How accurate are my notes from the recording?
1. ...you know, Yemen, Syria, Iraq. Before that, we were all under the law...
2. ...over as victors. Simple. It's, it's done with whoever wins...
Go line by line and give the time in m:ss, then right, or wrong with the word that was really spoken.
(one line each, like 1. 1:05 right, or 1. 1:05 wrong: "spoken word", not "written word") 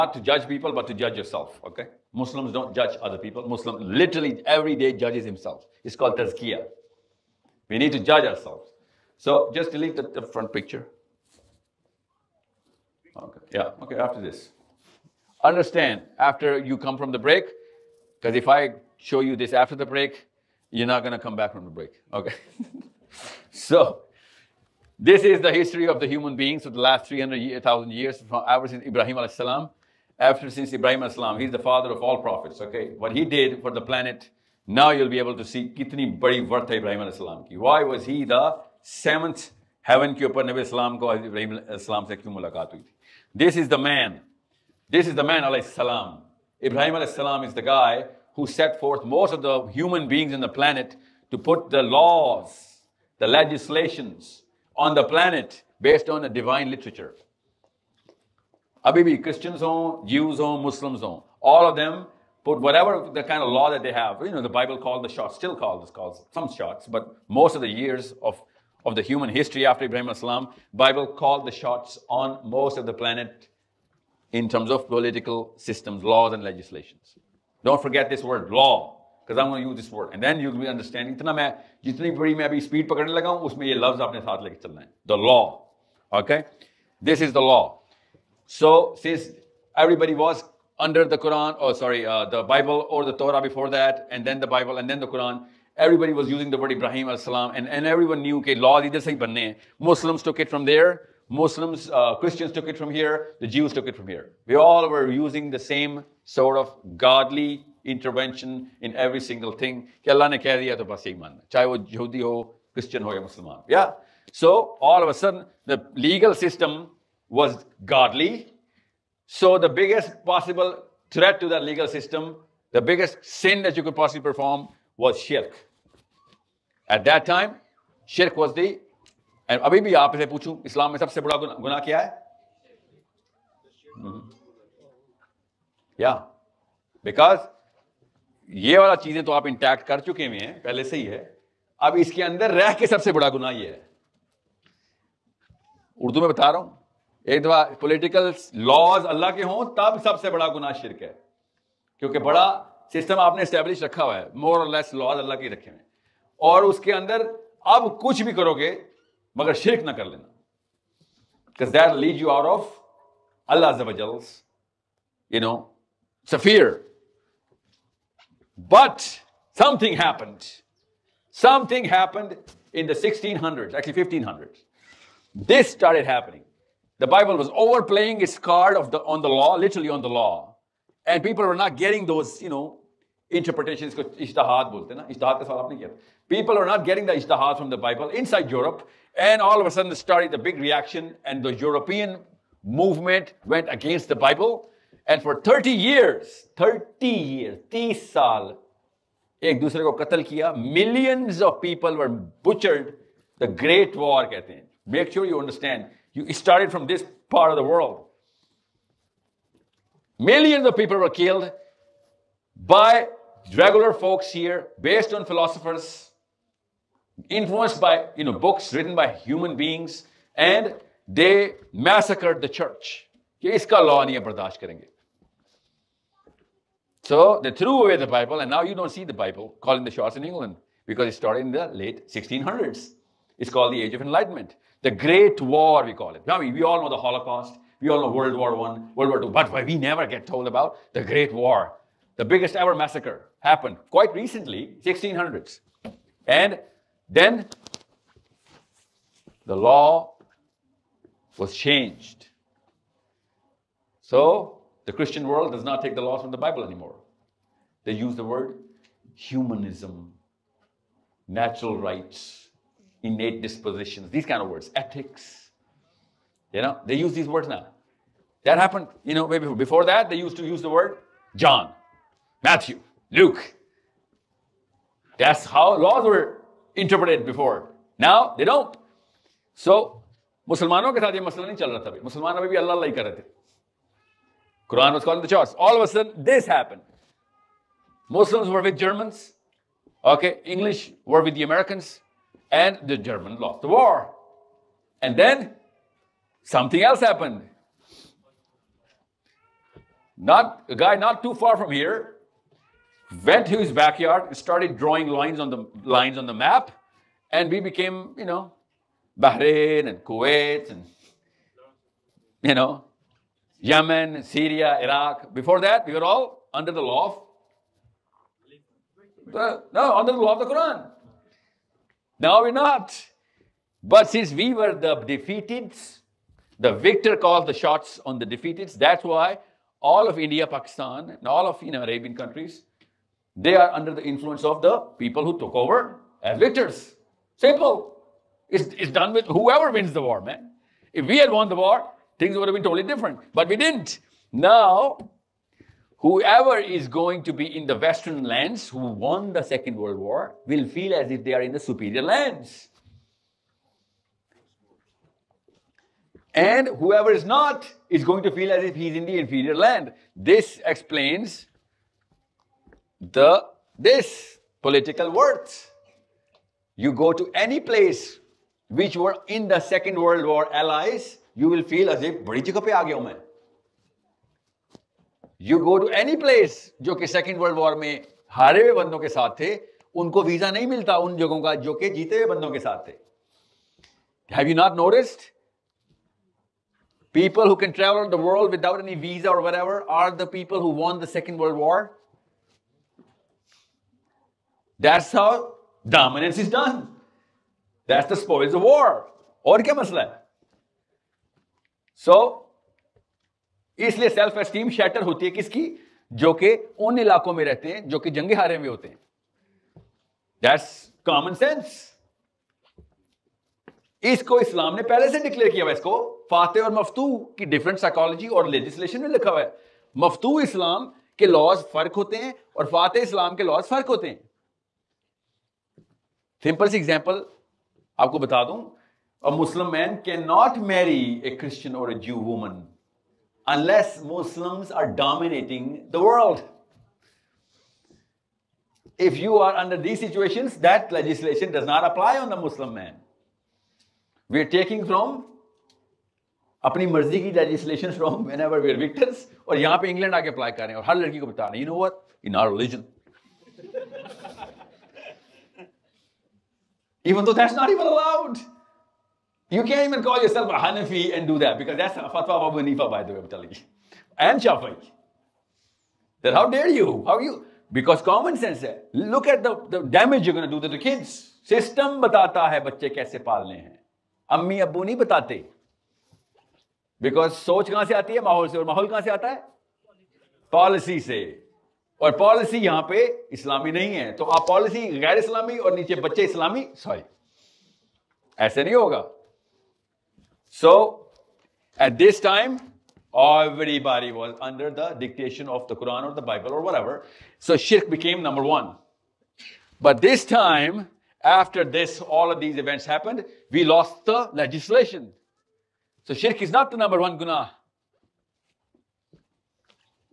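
1. 5:12 right
2. 5:35 right.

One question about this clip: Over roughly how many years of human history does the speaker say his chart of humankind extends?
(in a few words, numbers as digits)
300,000 years.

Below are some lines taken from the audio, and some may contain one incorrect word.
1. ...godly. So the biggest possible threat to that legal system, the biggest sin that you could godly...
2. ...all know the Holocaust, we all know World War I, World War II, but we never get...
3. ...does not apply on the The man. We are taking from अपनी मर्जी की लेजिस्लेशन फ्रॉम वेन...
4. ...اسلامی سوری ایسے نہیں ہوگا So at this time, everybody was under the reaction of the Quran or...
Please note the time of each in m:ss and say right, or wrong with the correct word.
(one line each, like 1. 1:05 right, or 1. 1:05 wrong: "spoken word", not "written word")
1. 1:57 wrong: "possibly", not "godly"
2. 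3:56 right
3. 7:21 wrong: "Muslim", not "The"
4. 8:06 wrong: "dictation", not "reaction".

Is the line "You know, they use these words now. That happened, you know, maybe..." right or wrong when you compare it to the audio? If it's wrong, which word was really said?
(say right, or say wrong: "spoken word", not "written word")
right.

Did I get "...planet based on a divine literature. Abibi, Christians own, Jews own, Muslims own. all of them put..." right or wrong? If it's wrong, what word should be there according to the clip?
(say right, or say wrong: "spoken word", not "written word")
right.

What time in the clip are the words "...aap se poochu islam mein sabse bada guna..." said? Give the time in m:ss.
2:09.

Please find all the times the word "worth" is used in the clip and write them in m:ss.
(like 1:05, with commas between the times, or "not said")
0:36, 6:05.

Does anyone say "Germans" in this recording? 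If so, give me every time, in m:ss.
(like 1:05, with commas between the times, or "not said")
4:48, 4:52.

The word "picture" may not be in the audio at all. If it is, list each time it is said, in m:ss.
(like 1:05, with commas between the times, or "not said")
0:10.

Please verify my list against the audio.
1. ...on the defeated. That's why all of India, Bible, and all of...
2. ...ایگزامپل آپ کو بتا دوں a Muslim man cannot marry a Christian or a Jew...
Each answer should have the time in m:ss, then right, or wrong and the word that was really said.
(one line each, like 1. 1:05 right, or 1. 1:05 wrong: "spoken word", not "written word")
1. 5:28 wrong: "Pakistan", not "Bible"
2. 7:06 right.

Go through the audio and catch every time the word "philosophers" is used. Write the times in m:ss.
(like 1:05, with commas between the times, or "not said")
3:35.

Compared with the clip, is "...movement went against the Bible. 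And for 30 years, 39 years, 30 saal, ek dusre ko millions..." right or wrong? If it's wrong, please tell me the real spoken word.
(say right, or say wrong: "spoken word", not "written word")
wrong: "30", not "39".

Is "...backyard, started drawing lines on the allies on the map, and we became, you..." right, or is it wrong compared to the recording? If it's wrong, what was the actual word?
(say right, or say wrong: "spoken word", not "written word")
wrong: "lines", not "allies".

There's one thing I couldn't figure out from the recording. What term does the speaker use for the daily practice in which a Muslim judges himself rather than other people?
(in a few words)
Tazkiyah.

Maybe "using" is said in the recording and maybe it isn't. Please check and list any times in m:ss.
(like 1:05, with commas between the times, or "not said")
1:36, 1:45.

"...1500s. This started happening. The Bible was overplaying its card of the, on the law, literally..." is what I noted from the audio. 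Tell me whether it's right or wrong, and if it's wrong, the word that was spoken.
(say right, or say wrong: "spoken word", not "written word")
right.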